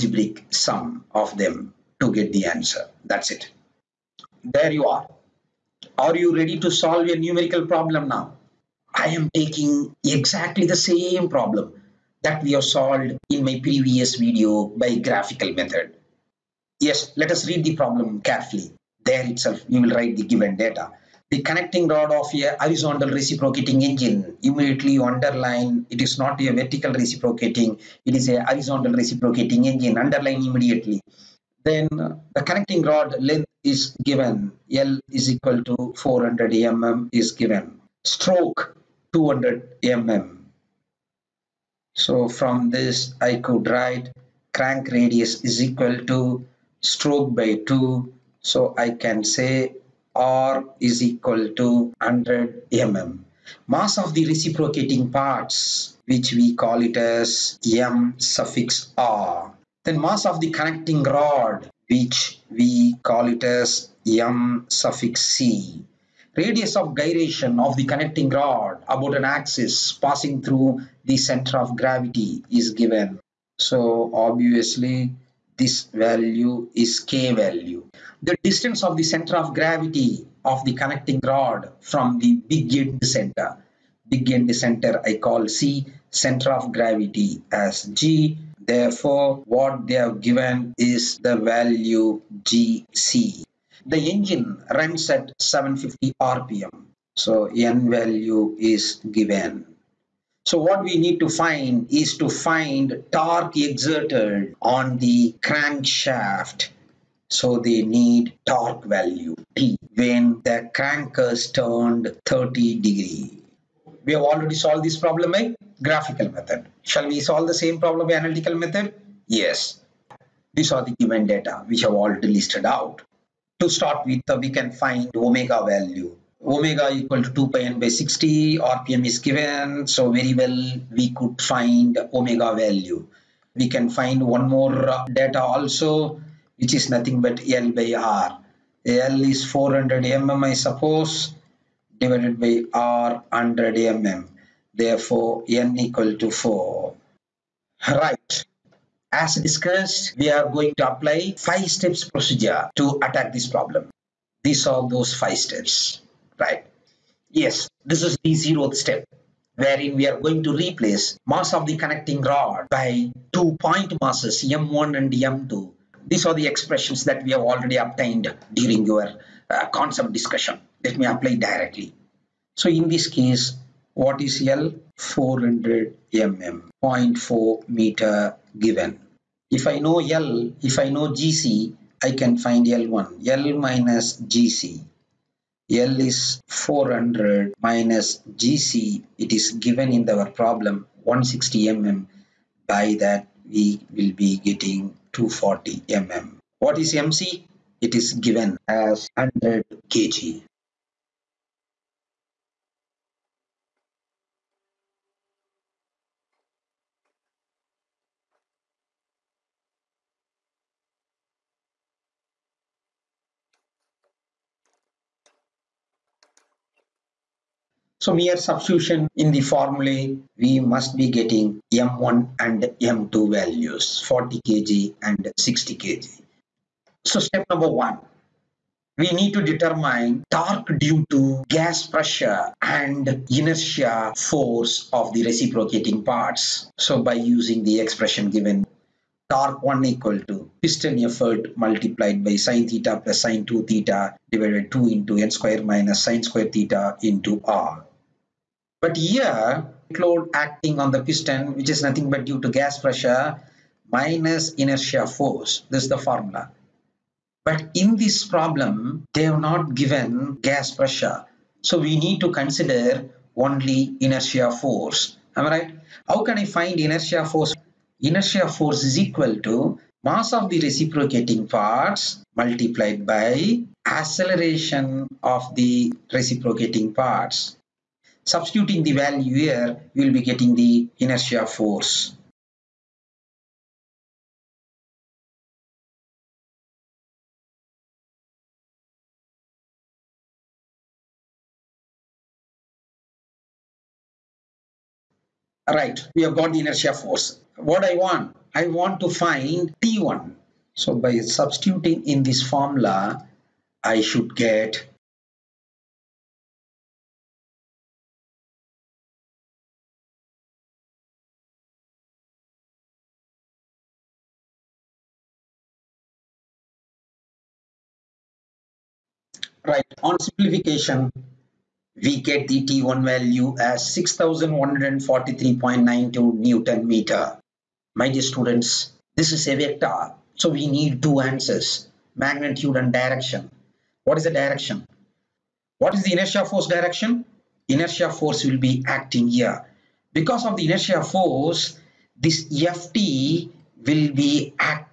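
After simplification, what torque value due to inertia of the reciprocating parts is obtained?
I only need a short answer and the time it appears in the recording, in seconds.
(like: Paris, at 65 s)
6,143.92 N·m, at 323 s.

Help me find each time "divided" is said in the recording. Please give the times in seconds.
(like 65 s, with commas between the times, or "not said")
141 s, 244 s.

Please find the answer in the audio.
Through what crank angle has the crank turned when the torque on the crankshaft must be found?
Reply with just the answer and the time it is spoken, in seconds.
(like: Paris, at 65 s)
30 degrees, at 112 s.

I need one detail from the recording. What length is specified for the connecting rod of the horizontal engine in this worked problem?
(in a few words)
400 mm.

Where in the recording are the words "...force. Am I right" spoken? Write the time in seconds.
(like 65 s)
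264 s.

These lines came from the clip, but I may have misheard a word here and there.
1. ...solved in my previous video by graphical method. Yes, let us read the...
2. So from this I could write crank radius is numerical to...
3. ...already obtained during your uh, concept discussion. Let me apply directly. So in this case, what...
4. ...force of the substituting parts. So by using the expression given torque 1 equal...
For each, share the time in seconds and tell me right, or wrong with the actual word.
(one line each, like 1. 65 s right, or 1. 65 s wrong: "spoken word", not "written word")
1. 12 s right
2. 41 s wrong: "equal", not "numerical"
3. 167 s right
4. 234 s wrong: "reciprocating", not "substituting".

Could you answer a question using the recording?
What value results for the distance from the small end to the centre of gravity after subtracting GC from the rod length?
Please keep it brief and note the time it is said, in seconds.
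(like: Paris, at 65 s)
240 mm, at 195 s.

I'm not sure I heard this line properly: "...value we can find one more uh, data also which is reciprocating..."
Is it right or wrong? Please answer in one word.
wrong.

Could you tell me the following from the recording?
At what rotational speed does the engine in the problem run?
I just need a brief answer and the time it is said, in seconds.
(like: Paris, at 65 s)
750 RPM, at 95 s.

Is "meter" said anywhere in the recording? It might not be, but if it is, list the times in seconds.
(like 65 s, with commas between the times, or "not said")
177 s, 326 s.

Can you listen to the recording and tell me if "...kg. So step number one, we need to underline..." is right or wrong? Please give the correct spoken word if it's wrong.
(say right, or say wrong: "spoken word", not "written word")
wrong: "determine", not "underline".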